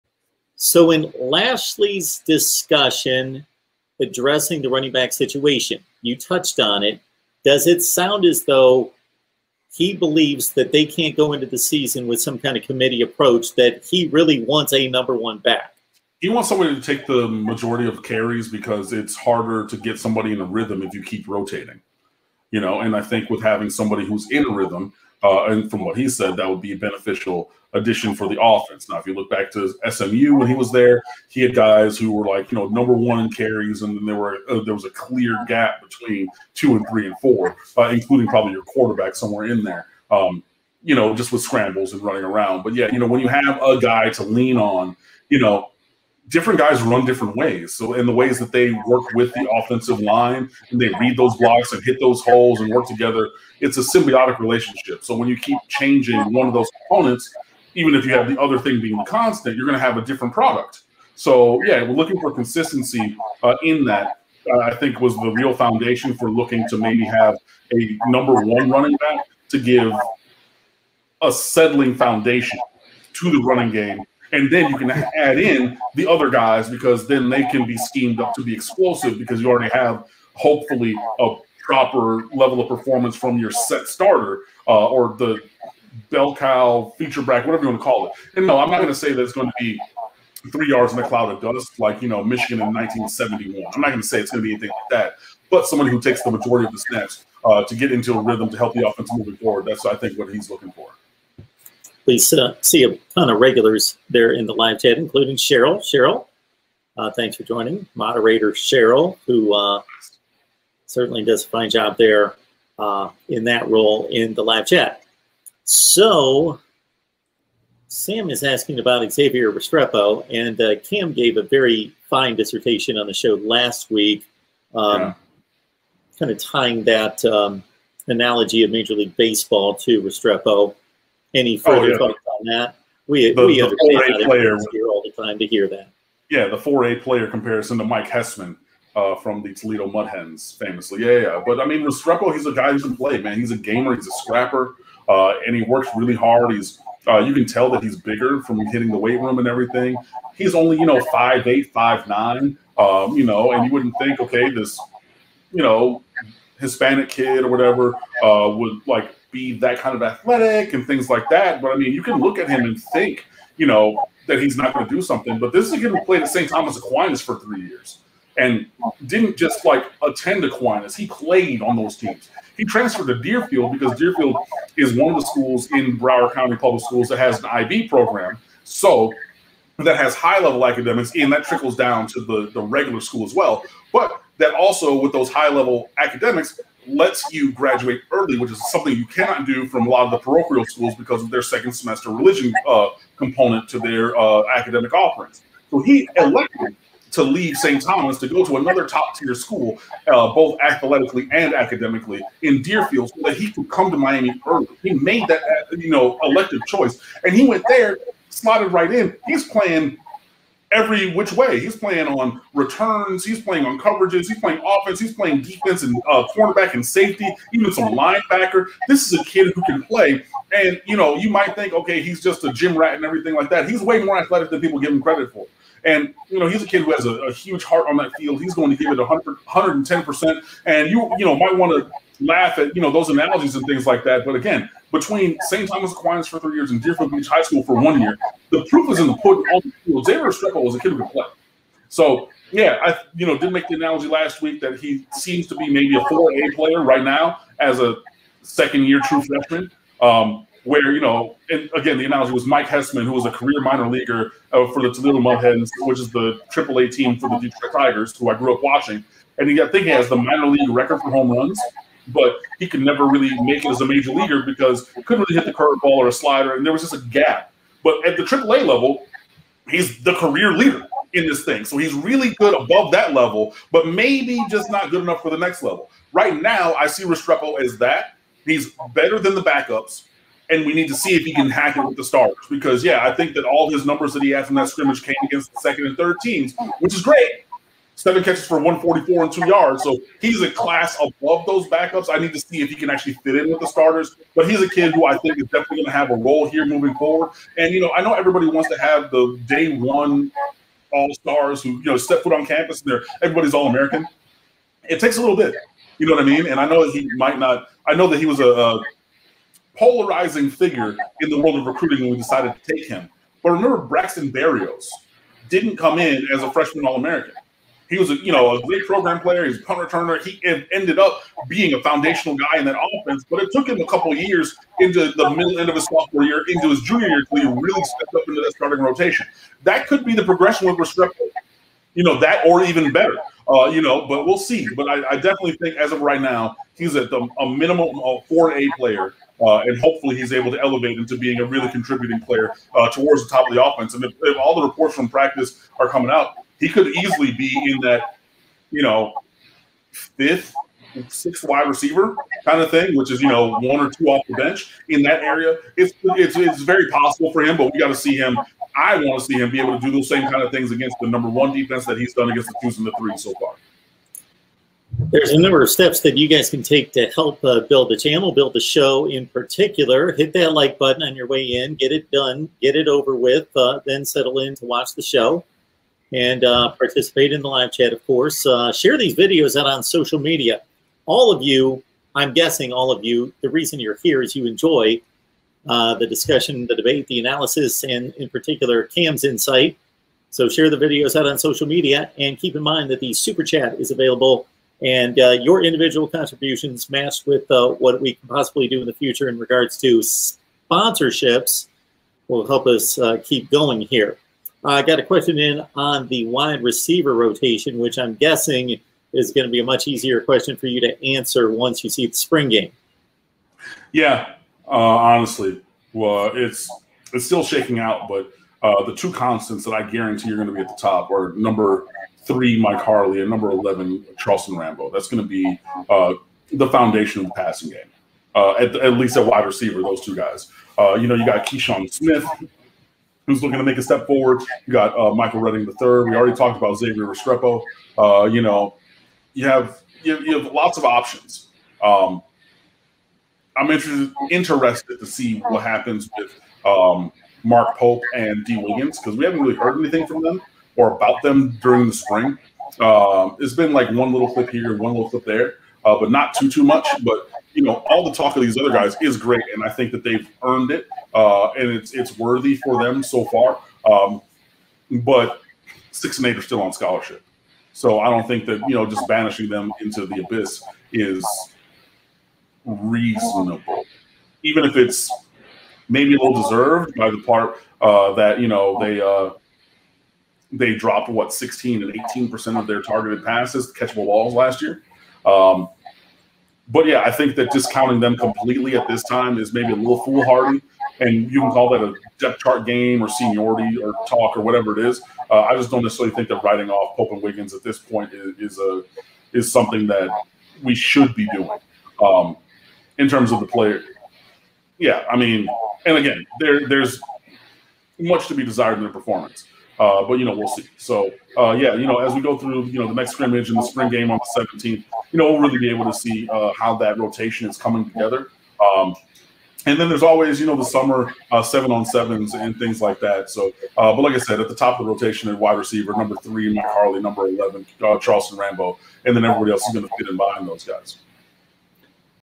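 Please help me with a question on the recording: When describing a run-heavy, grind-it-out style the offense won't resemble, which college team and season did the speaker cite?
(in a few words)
Michigan in 1971.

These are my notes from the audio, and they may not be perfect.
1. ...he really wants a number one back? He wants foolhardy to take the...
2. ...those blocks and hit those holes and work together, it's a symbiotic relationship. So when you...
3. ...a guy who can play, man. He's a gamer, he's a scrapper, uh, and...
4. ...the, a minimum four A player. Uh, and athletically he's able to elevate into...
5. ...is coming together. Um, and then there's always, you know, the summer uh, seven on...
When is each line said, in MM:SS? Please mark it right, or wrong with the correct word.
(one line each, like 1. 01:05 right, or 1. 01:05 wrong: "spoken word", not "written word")
1. 00:13 wrong: "somebody", not "foolhardy"
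2. 00:51 right
3. 02:22 right
4. 05:37 wrong: "hopefully", not "athletically"
5. 08:37 right.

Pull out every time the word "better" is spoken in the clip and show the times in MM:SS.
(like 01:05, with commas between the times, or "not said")
04:38, 05:32.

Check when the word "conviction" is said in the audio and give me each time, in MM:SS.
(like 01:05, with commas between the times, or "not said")
not said.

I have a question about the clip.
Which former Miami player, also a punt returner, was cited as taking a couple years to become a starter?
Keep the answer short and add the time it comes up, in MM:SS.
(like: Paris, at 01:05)
Braxton Berrios, at 05:13.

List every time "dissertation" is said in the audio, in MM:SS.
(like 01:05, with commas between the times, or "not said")
02:02.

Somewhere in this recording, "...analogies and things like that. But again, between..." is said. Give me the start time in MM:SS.
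03:53.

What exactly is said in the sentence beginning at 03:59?
All the Xavier Restrepo was a kid who could play.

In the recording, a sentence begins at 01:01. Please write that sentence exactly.
So yeah, we're looking for consistency uh, in that.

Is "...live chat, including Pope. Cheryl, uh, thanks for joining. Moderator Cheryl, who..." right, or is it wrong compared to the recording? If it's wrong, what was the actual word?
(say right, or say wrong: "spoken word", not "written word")
wrong: "Cheryl", not "Pope".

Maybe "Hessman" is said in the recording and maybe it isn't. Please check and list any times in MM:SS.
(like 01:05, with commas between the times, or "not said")
02:18, 04:12.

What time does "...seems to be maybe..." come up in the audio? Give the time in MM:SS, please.
04:05.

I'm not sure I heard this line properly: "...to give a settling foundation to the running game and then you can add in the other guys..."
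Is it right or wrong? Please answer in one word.
right.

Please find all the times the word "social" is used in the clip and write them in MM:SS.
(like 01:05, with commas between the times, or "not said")
06:19, 06:31.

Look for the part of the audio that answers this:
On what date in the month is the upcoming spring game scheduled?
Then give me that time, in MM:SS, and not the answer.
08:34.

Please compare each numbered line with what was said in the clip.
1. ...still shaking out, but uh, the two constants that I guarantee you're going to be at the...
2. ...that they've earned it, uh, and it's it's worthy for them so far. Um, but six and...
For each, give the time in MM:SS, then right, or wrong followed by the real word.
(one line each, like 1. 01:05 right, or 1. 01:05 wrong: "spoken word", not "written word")
1. 06:57 right
2. 07:39 right.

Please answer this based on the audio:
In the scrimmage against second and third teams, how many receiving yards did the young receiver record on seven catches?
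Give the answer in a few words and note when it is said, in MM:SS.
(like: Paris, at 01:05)
144, at 04:48.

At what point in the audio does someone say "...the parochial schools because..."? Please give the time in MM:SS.
03:10.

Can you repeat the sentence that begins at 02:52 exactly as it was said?
He transferred to Deerfield because Deerfield is one of the schools in Broward County Public Schools that has an IB program.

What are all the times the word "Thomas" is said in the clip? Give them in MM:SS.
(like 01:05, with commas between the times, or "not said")
02:46, 03:17, 03:55.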